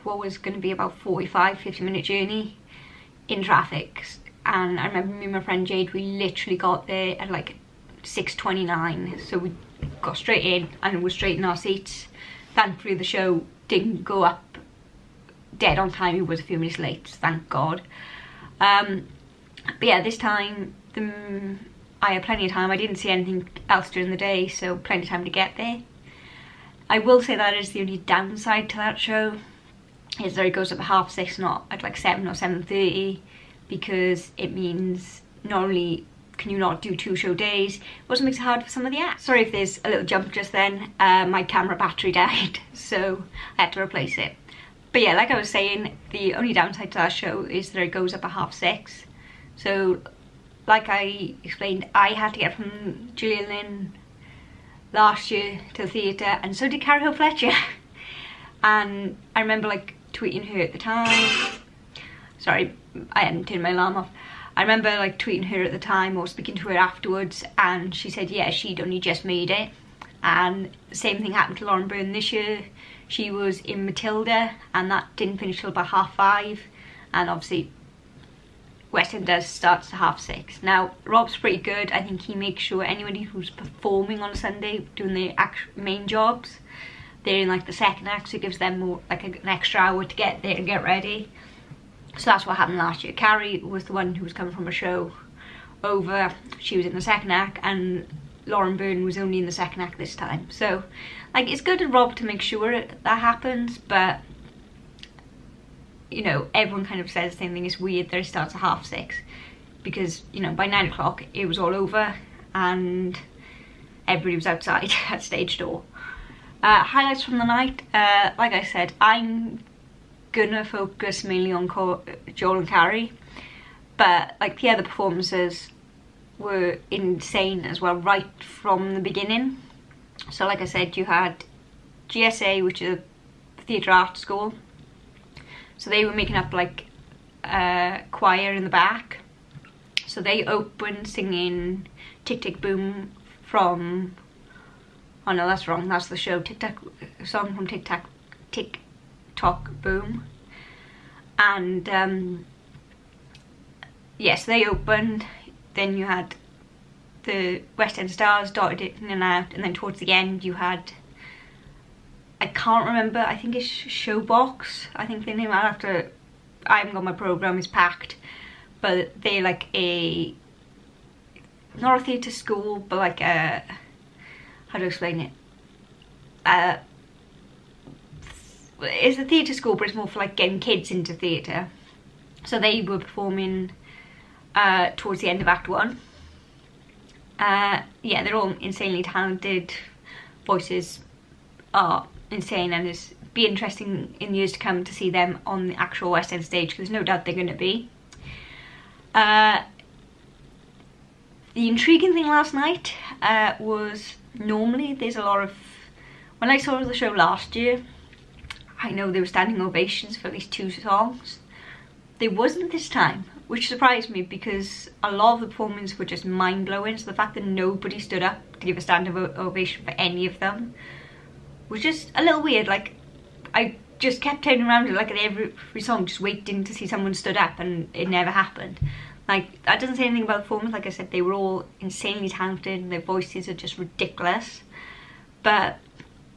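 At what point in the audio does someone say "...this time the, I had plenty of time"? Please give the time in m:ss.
0:20.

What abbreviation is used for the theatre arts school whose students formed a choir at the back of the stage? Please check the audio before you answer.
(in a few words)
GSA.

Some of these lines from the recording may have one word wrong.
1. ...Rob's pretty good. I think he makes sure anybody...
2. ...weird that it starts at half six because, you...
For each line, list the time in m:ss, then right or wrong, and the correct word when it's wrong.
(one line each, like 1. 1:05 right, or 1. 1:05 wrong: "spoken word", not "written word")
1. 1:21 right
2. 1:47 right.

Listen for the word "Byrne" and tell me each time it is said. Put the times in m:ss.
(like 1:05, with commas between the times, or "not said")
1:11, 1:38.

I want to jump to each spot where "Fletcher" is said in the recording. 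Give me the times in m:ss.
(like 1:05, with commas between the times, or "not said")
0:57.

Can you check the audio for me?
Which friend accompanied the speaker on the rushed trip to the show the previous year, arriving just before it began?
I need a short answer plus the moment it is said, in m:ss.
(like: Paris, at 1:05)
Jade, at 0:05.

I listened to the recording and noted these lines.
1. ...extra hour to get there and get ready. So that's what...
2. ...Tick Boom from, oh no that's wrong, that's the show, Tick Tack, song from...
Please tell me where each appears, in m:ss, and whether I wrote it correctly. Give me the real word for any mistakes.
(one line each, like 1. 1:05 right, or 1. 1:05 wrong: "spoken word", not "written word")
1. 1:29 right
2. 2:22 right.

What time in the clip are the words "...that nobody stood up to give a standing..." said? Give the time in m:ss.
3:37.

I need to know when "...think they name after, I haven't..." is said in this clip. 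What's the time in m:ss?
2:45.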